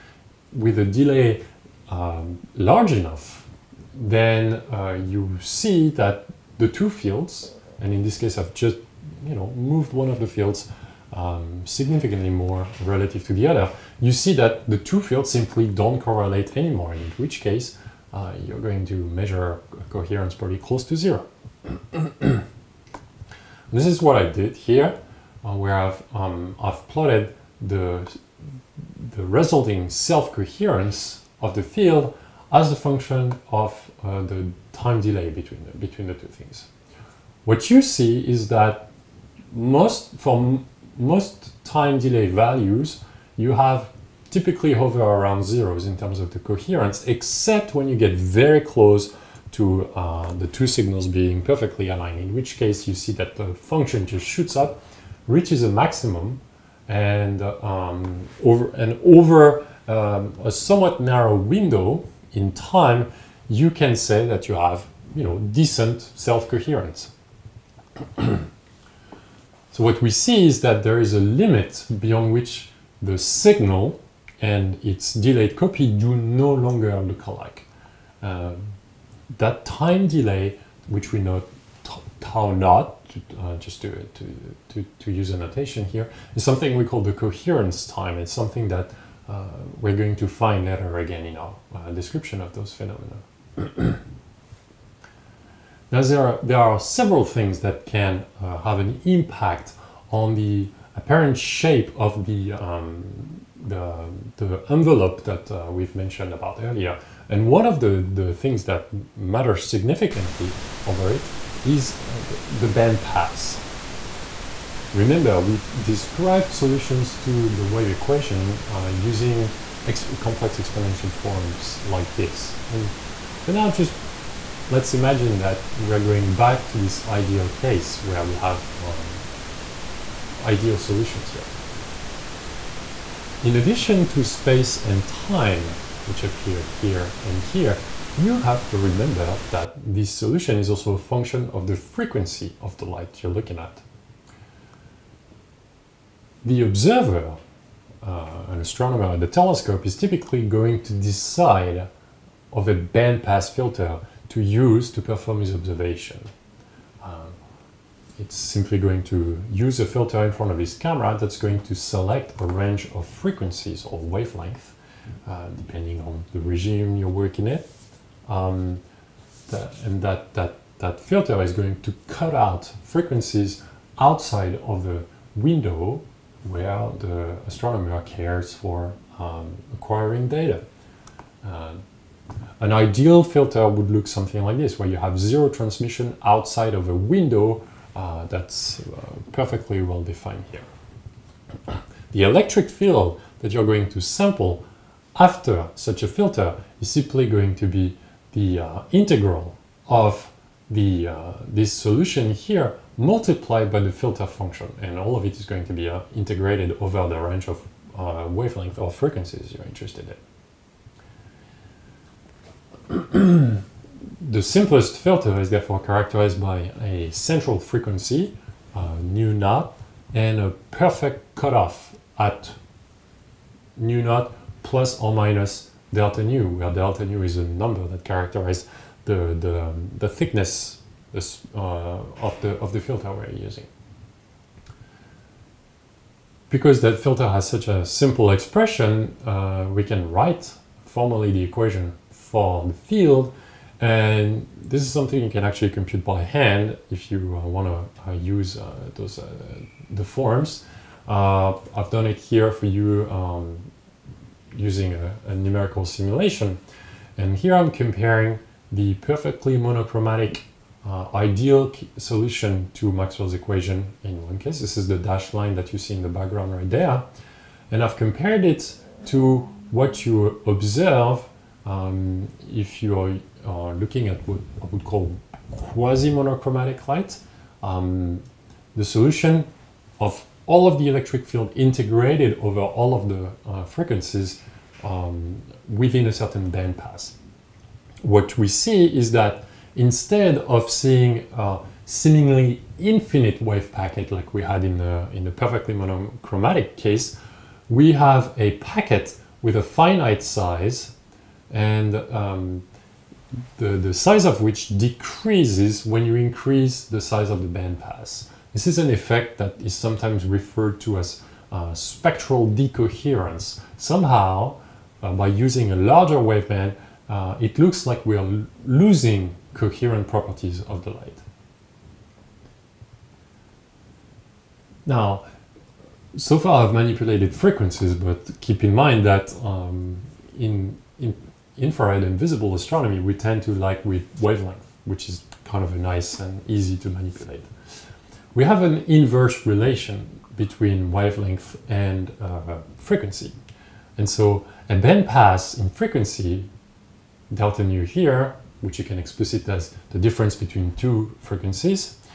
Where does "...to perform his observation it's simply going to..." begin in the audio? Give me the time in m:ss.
2:34.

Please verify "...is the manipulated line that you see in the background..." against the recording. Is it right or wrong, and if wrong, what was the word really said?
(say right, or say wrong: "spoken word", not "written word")
wrong: "dashed", not "manipulated".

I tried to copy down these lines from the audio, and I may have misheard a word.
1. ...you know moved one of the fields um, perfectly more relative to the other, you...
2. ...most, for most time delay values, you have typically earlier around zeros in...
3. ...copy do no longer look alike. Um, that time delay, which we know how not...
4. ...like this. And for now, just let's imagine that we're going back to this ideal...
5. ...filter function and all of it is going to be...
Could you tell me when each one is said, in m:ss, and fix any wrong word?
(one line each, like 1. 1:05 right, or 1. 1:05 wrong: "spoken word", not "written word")
1. 0:09 wrong: "significantly", not "perfectly"
2. 0:39 wrong: "hover", not "earlier"
3. 1:15 right
4. 2:01 right
5. 3:23 right.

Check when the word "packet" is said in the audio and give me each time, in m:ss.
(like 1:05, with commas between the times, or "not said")
4:53, 4:58.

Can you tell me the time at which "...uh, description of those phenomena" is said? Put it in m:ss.
1:31.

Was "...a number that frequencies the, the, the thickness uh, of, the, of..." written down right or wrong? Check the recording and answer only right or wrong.
wrong.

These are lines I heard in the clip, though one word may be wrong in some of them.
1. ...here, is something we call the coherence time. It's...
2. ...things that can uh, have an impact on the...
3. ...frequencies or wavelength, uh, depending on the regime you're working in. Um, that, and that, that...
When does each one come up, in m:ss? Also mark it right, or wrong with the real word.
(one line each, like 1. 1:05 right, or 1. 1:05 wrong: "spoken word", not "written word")
1. 1:25 right
2. 1:37 right
3. 2:43 right.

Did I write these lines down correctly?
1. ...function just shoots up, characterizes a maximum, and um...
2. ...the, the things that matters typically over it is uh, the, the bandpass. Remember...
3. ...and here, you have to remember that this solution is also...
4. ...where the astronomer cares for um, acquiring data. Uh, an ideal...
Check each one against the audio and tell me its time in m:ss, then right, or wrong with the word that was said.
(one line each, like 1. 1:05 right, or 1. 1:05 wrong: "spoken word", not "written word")
1. 0:53 wrong: "reaches", not "characterizes"
2. 1:47 wrong: "significantly", not "typically"
3. 2:17 right
4. 2:56 right.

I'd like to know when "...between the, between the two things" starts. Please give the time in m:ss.
0:35.